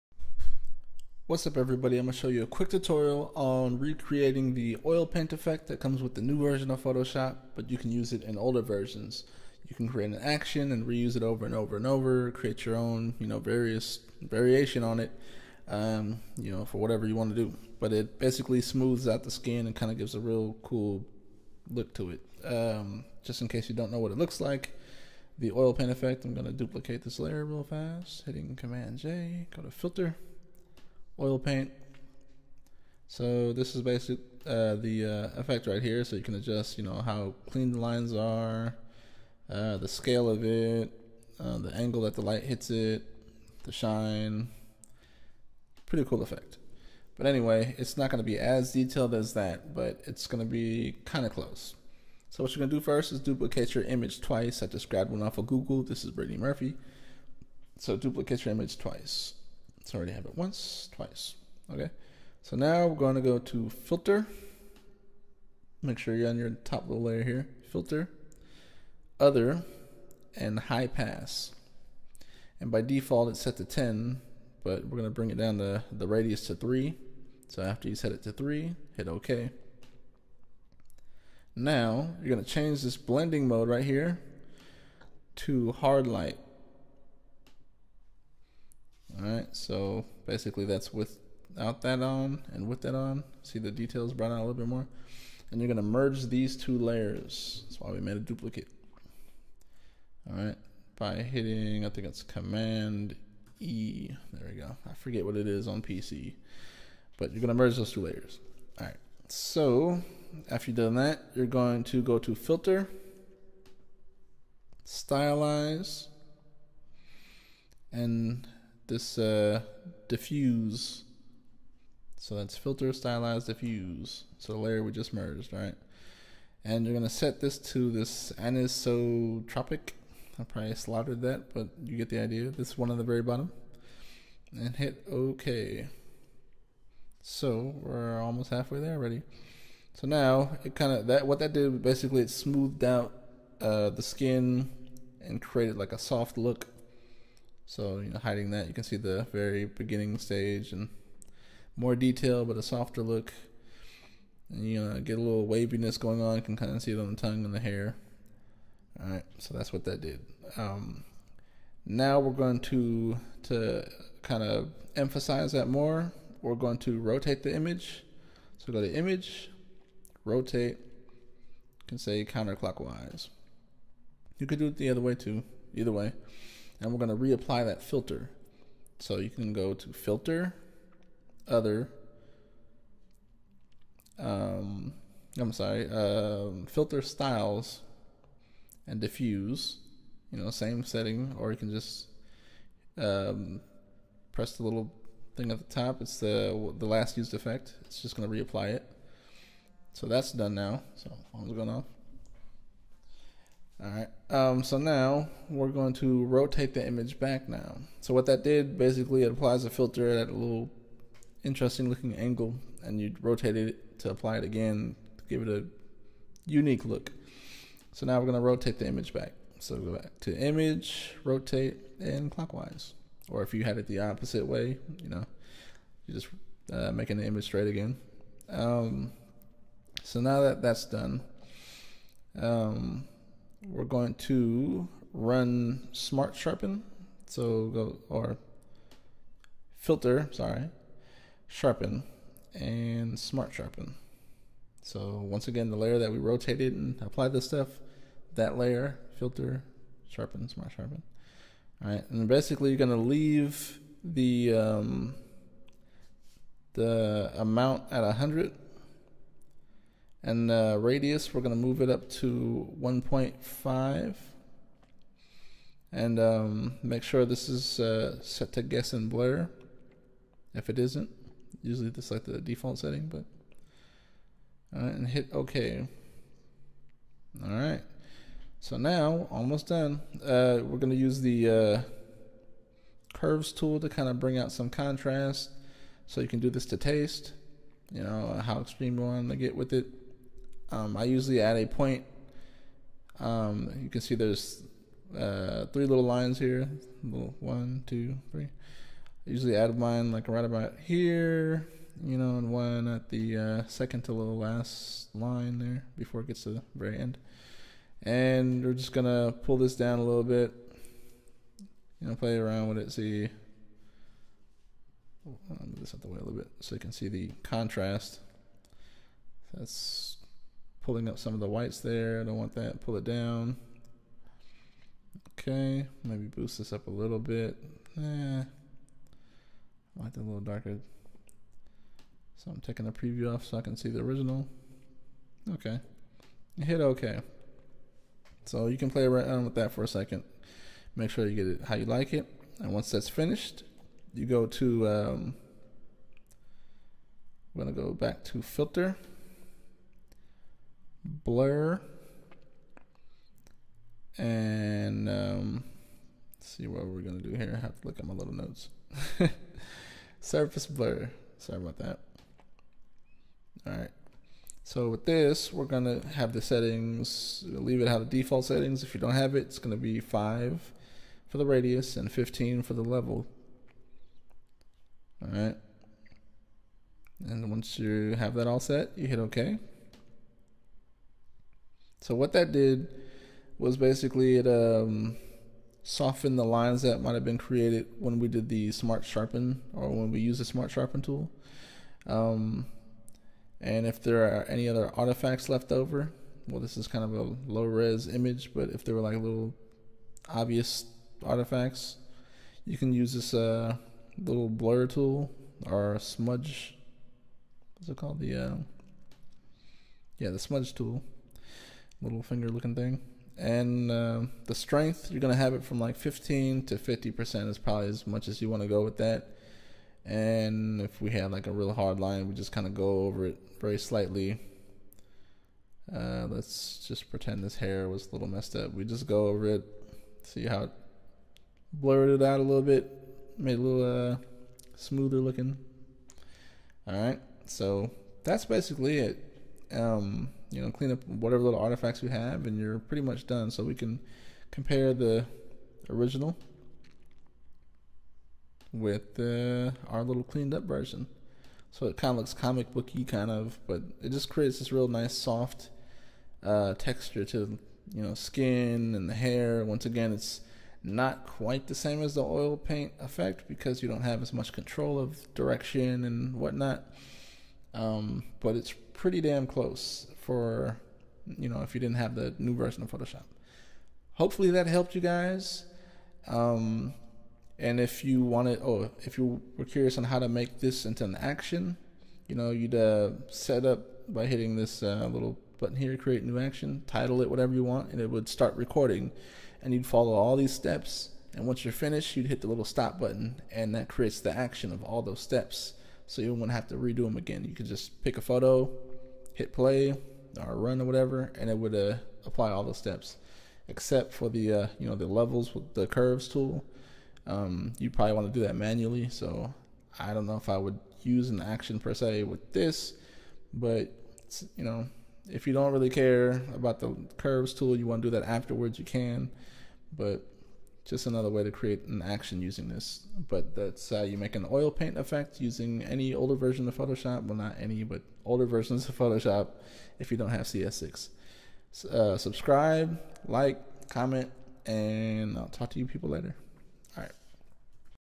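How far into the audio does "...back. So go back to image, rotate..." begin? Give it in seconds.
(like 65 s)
219 s.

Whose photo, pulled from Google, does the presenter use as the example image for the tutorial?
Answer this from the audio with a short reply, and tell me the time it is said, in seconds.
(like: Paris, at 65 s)
Brittany Murphy, at 56 s.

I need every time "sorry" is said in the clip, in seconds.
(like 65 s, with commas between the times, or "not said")
185 s, 240 s, 361 s.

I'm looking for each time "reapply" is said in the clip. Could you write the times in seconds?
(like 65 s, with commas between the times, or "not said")
177 s, 198 s.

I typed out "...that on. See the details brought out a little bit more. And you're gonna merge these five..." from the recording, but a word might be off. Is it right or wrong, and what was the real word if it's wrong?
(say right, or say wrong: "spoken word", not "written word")
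wrong: "two", not "five".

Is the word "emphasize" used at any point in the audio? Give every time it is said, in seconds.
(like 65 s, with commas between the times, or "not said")
164 s.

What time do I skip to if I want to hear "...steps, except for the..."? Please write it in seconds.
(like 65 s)
502 s.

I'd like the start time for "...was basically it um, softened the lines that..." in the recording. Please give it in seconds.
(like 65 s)
383 s.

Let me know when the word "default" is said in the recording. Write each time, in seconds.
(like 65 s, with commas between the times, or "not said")
72 s, 272 s, 368 s.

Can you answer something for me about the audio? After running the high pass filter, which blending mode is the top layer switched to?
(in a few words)
Hard light.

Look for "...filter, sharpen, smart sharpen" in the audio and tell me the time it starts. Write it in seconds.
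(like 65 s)
249 s.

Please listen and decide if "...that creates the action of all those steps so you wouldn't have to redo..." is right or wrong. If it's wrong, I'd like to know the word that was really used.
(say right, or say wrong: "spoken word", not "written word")
right.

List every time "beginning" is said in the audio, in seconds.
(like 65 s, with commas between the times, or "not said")
149 s.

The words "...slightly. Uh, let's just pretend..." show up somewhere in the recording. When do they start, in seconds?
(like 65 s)
423 s.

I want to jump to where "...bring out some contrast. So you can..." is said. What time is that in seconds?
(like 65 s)
284 s.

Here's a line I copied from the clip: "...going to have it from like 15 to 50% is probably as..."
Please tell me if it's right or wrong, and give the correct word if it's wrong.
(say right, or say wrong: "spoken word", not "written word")
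right.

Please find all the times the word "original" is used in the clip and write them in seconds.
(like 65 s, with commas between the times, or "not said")
333 s, 445 s.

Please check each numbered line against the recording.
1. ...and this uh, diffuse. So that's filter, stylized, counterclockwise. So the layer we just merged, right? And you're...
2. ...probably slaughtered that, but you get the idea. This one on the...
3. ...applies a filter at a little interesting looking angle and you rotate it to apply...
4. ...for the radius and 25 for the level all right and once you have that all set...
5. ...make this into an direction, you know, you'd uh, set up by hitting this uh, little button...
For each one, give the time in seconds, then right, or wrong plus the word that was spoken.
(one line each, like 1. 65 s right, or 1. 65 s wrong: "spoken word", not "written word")
1. 117 s wrong: "diffuse", not "counterclockwise"
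2. 130 s right
3. 209 s right
4. 371 s wrong: "15", not "25"
5. 480 s wrong: "action", not "direction".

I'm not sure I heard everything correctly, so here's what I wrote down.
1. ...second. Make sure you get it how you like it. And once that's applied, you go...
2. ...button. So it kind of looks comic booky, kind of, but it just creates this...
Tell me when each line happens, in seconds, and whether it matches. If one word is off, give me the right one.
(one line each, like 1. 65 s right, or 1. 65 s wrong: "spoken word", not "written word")
1. 339 s wrong: "finished", not "applied"
2. 450 s wrong: "version", not "button".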